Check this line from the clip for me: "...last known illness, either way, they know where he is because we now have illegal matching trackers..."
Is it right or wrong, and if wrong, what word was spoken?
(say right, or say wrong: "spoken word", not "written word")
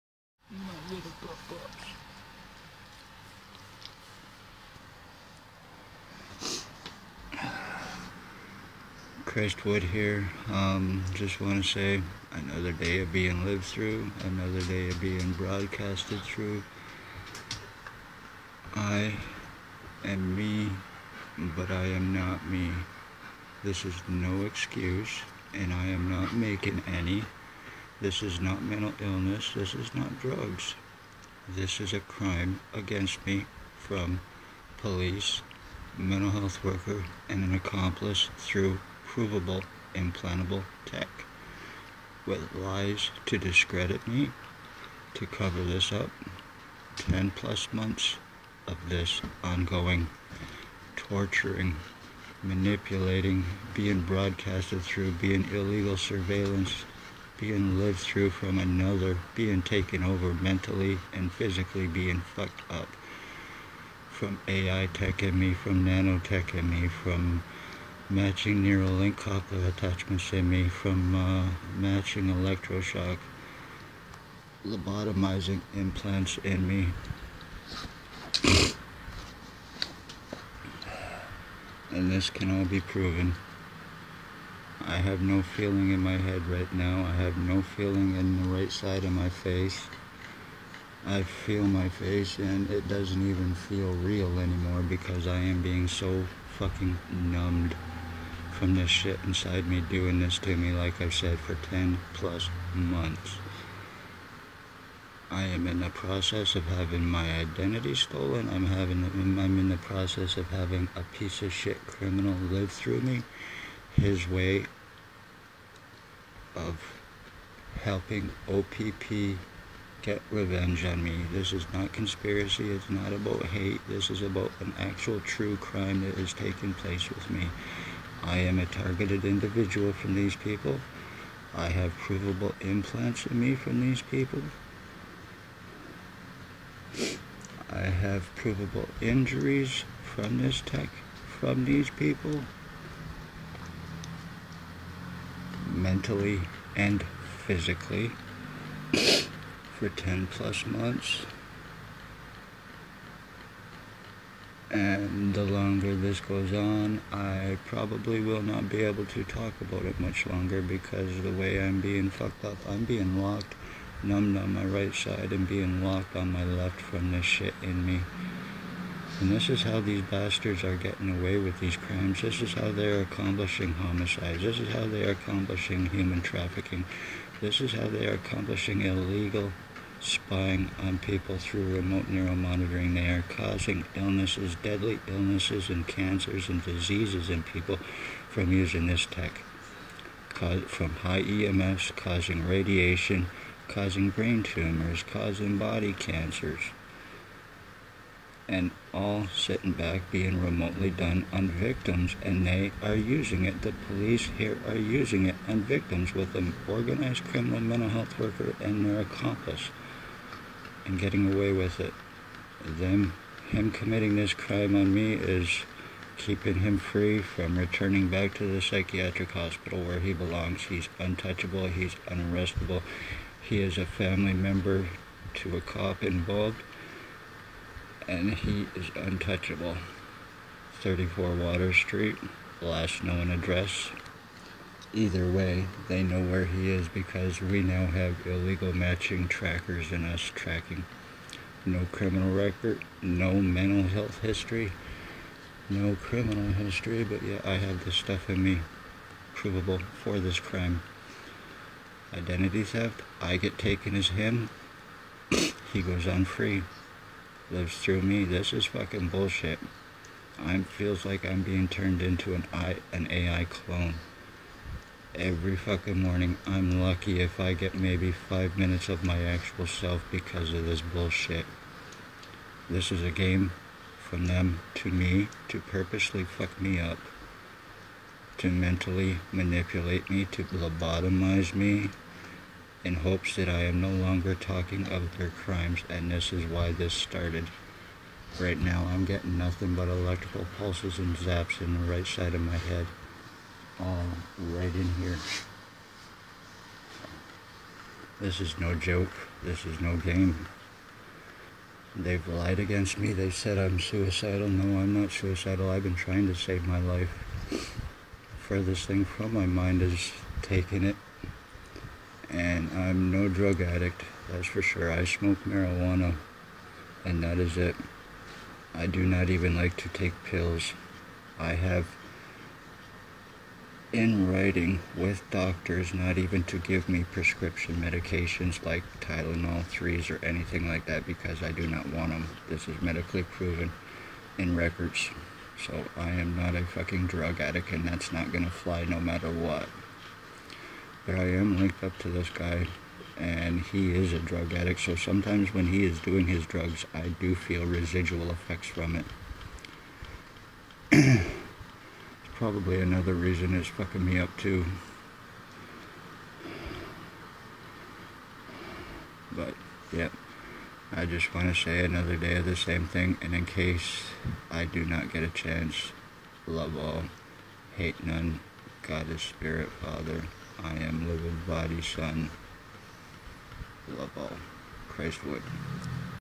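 wrong: "address", not "illness".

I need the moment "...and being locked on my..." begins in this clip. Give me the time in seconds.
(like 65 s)
165 s.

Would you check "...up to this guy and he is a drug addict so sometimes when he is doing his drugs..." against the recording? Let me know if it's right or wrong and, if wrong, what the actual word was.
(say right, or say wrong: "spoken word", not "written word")
right.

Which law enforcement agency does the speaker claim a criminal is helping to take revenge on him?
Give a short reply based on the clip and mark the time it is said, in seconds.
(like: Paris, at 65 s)
OPP, at 118 s.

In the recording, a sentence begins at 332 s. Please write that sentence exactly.
This is medically proven in records.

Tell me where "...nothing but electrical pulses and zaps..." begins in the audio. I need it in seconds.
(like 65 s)
289 s.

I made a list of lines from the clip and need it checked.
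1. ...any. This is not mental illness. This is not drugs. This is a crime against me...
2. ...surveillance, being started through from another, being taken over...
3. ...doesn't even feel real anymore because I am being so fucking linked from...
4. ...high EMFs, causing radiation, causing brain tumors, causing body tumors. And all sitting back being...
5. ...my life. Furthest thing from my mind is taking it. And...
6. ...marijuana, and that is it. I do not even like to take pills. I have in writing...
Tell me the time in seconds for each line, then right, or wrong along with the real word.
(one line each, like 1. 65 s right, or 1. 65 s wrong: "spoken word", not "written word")
1. 26 s right
2. 55 s wrong: "lived", not "started"
3. 92 s wrong: "numbed", not "linked"
4. 191 s wrong: "cancers", not "tumors"
5. 306 s right
6. 315 s right.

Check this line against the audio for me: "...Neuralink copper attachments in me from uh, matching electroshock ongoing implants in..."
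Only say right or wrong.
wrong.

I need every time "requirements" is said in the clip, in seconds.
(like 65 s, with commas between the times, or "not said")
not said.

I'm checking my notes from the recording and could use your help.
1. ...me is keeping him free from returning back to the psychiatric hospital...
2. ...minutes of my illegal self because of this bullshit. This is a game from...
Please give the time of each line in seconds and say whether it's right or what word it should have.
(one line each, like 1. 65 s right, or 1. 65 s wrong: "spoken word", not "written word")
1. 214 s right
2. 268 s wrong: "actual", not "illegal".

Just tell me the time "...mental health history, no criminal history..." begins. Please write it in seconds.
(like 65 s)
243 s.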